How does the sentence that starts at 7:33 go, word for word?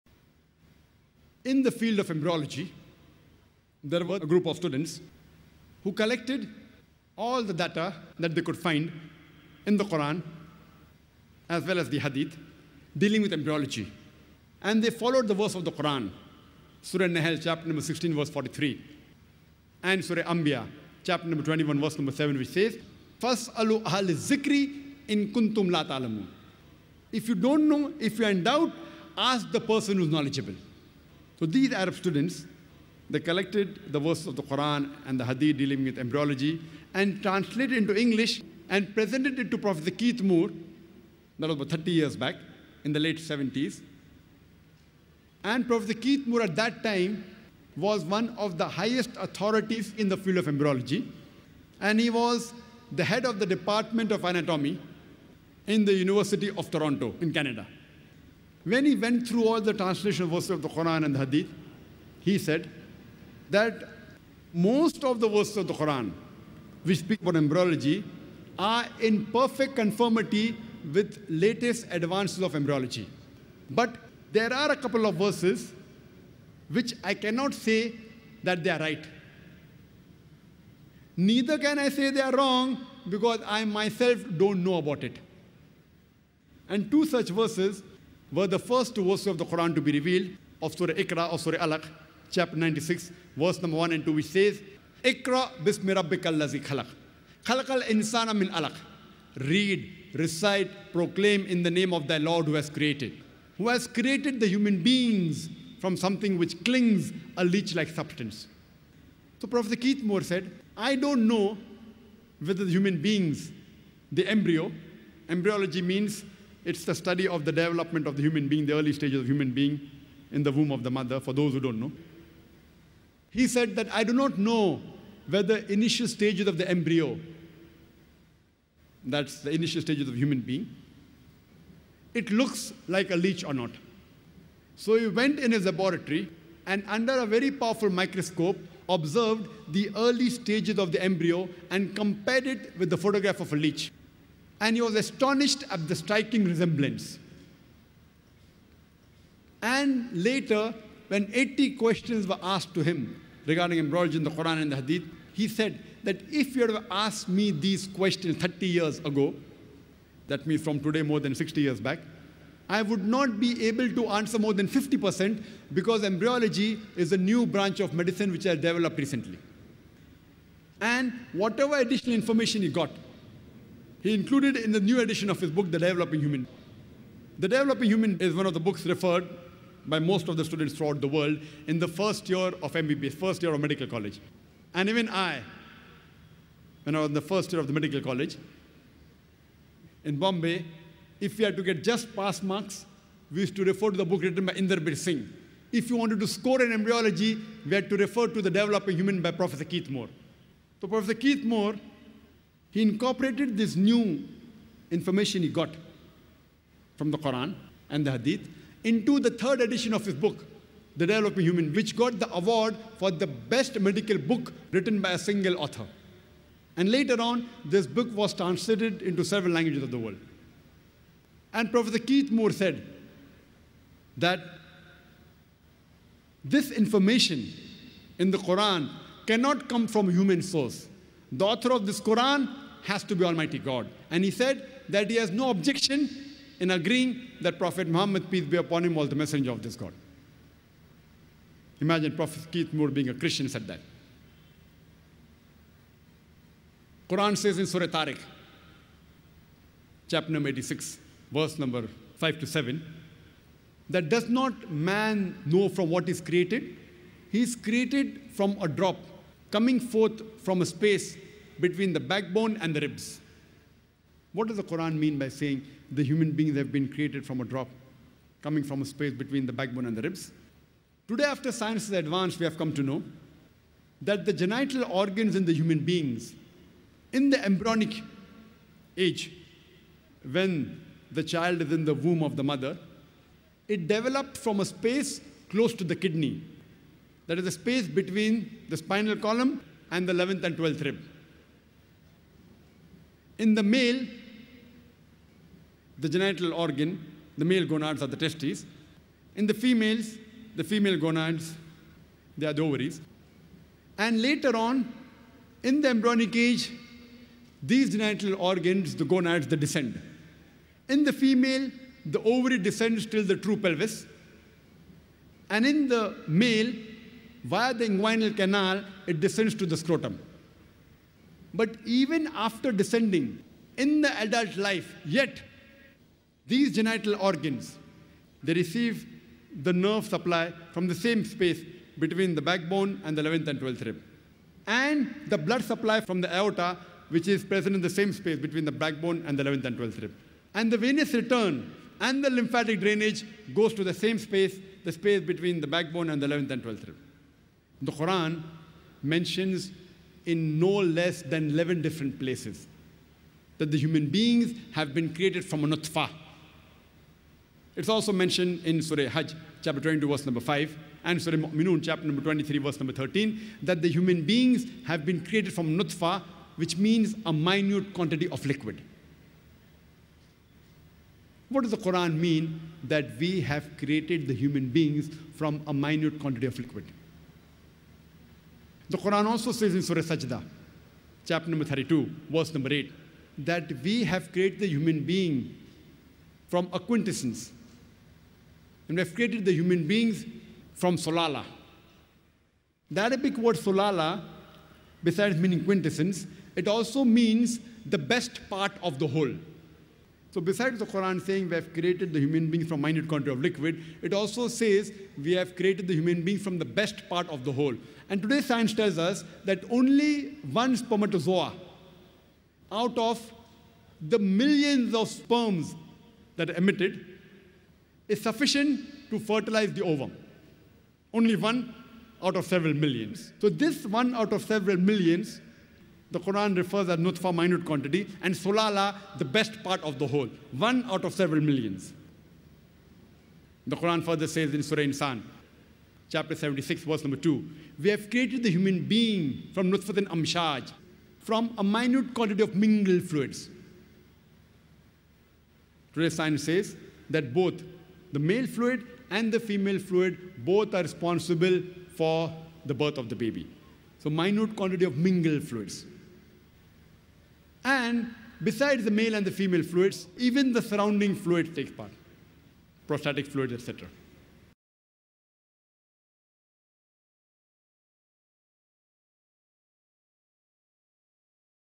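So minute quantity of mingled fluids.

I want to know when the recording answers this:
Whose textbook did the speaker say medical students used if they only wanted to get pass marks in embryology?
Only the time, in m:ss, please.
3:14.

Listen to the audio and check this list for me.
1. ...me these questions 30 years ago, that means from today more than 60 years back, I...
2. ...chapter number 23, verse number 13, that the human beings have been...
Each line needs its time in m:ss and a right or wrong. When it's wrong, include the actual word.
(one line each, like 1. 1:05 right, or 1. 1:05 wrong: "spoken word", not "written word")
1. 2:37 right
2. 6:01 right.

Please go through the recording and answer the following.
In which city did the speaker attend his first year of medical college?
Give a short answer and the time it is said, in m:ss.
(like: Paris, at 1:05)
Bombay, at 3:10.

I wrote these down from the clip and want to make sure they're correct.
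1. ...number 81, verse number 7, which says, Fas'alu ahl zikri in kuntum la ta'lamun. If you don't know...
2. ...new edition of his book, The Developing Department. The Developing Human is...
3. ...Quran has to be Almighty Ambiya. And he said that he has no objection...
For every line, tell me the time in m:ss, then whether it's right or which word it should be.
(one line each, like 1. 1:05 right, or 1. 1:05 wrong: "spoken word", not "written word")
1. 0:21 wrong: "21", not "81"
2. 2:54 wrong: "Human", not "Department"
3. 3:52 wrong: "God", not "Ambiya".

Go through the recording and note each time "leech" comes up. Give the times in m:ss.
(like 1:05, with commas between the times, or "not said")
1:47, 2:13, 2:23.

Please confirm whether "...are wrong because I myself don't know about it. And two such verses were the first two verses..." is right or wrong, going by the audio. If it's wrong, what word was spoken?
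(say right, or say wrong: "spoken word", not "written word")
right.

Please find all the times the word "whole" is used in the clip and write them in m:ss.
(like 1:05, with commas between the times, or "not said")
6:39, 6:47, 7:10.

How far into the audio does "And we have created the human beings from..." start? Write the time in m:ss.
6:28.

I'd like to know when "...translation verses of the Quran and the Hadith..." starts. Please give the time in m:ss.
0:59.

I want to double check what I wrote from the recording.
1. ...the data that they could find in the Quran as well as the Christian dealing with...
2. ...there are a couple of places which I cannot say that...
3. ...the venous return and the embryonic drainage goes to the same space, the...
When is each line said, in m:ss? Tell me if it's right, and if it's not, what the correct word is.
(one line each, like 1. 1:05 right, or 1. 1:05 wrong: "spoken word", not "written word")
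1. 0:07 wrong: "Hadith", not "Christian"
2. 1:14 wrong: "verses", not "places"
3. 5:40 wrong: "lymphatic", not "embryonic".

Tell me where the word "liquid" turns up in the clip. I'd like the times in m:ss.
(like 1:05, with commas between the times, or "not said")
6:08, 6:16, 6:43.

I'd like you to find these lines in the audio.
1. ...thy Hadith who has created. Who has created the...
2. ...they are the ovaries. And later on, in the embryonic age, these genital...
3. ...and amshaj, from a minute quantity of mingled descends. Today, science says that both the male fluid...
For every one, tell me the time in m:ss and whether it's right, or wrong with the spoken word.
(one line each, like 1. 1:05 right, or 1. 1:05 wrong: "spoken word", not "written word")
1. 1:42 wrong: "Lord", not "Hadith"
2. 5:02 right
3. 7:19 wrong: "fluids", not "descends".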